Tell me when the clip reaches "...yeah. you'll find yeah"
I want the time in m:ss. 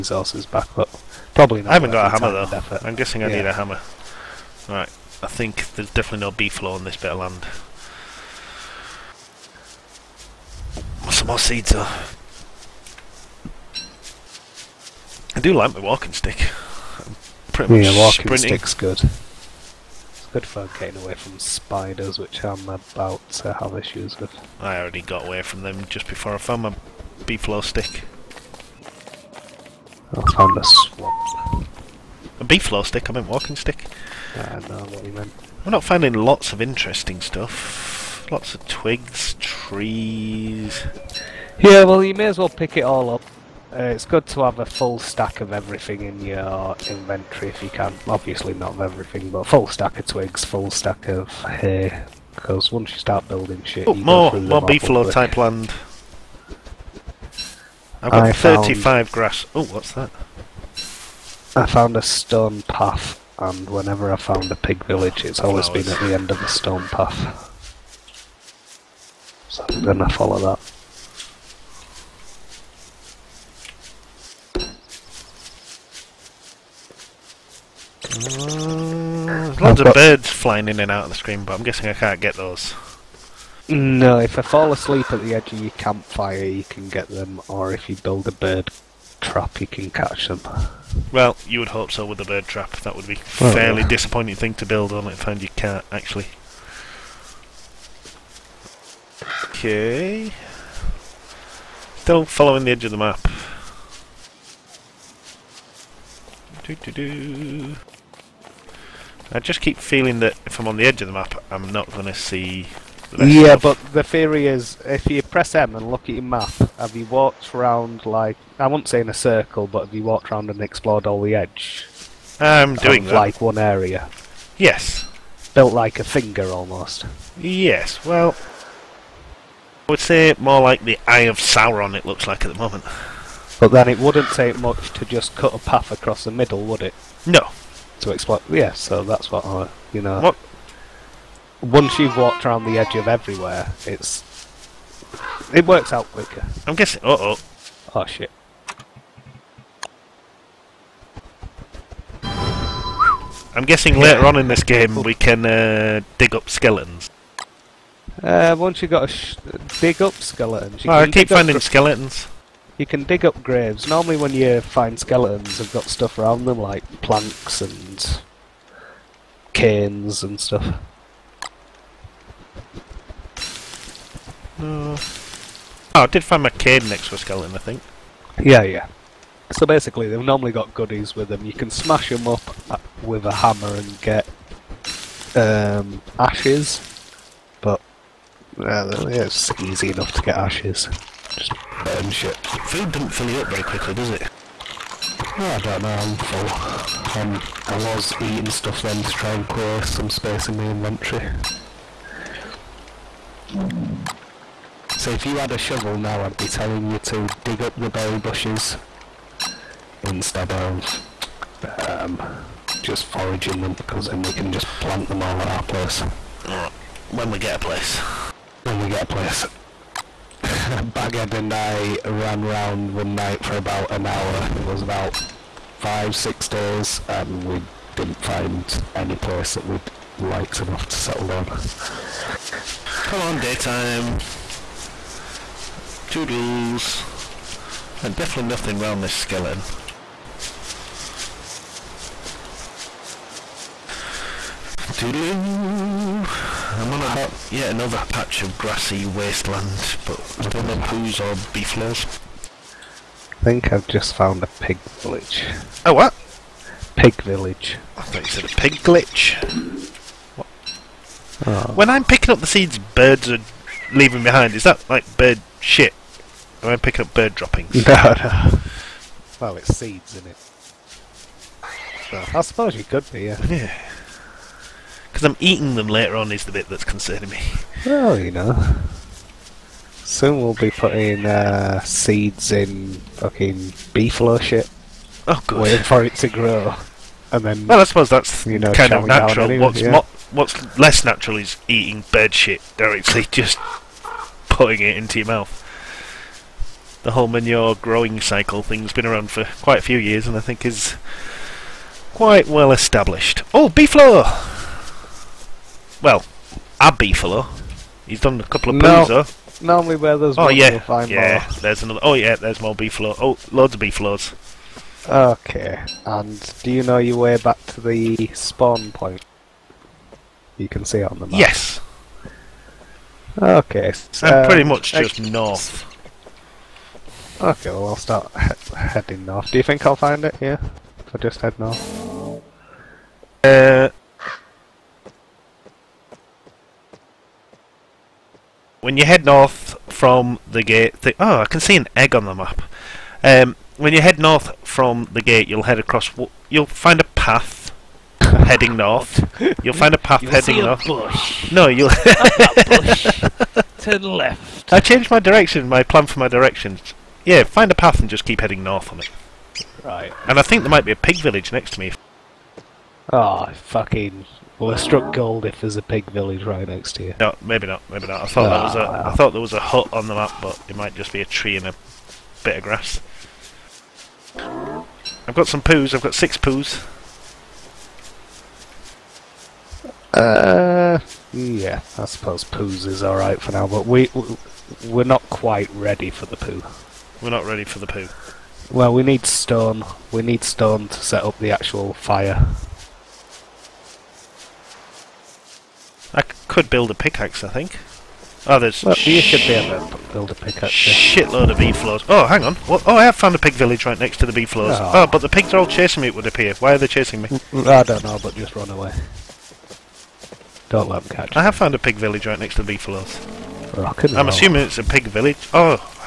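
5:10.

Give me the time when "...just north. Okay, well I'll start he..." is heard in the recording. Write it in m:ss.
5:24.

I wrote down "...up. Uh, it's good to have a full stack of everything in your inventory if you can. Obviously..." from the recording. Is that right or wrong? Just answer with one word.
right.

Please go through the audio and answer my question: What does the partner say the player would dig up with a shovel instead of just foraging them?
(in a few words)
Berry bushes.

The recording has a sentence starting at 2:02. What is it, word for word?
I'm doing of, like one area.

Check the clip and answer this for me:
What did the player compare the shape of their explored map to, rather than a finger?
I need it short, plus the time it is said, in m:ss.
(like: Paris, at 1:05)
The Eye of Sauron, at 2:11.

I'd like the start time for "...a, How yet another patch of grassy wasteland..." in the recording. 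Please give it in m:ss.
4:07.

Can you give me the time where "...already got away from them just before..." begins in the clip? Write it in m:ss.
0:24.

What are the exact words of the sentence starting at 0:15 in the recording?
I do like my walking stick.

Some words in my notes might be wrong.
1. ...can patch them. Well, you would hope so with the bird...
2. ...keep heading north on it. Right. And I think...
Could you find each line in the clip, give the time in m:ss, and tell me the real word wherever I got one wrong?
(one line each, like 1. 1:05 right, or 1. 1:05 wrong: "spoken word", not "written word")
1. 1:29 wrong: "catch", not "patch"
2. 5:58 right.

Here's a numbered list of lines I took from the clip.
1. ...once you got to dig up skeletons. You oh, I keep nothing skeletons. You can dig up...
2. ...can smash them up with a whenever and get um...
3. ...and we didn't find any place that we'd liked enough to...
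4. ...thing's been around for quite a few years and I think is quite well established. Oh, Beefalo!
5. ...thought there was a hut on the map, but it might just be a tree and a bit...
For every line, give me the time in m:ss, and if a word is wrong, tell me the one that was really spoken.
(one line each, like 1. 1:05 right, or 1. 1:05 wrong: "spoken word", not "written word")
1. 2:38 wrong: "finding", not "nothing"
2. 3:01 wrong: "hammer", not "whenever"
3. 3:47 right
4. 4:58 right
5. 6:09 right.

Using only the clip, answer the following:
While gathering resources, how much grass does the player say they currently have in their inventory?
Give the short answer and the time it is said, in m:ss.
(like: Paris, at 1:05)
35, at 0:58.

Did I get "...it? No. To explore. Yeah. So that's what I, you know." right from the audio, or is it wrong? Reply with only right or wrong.
right.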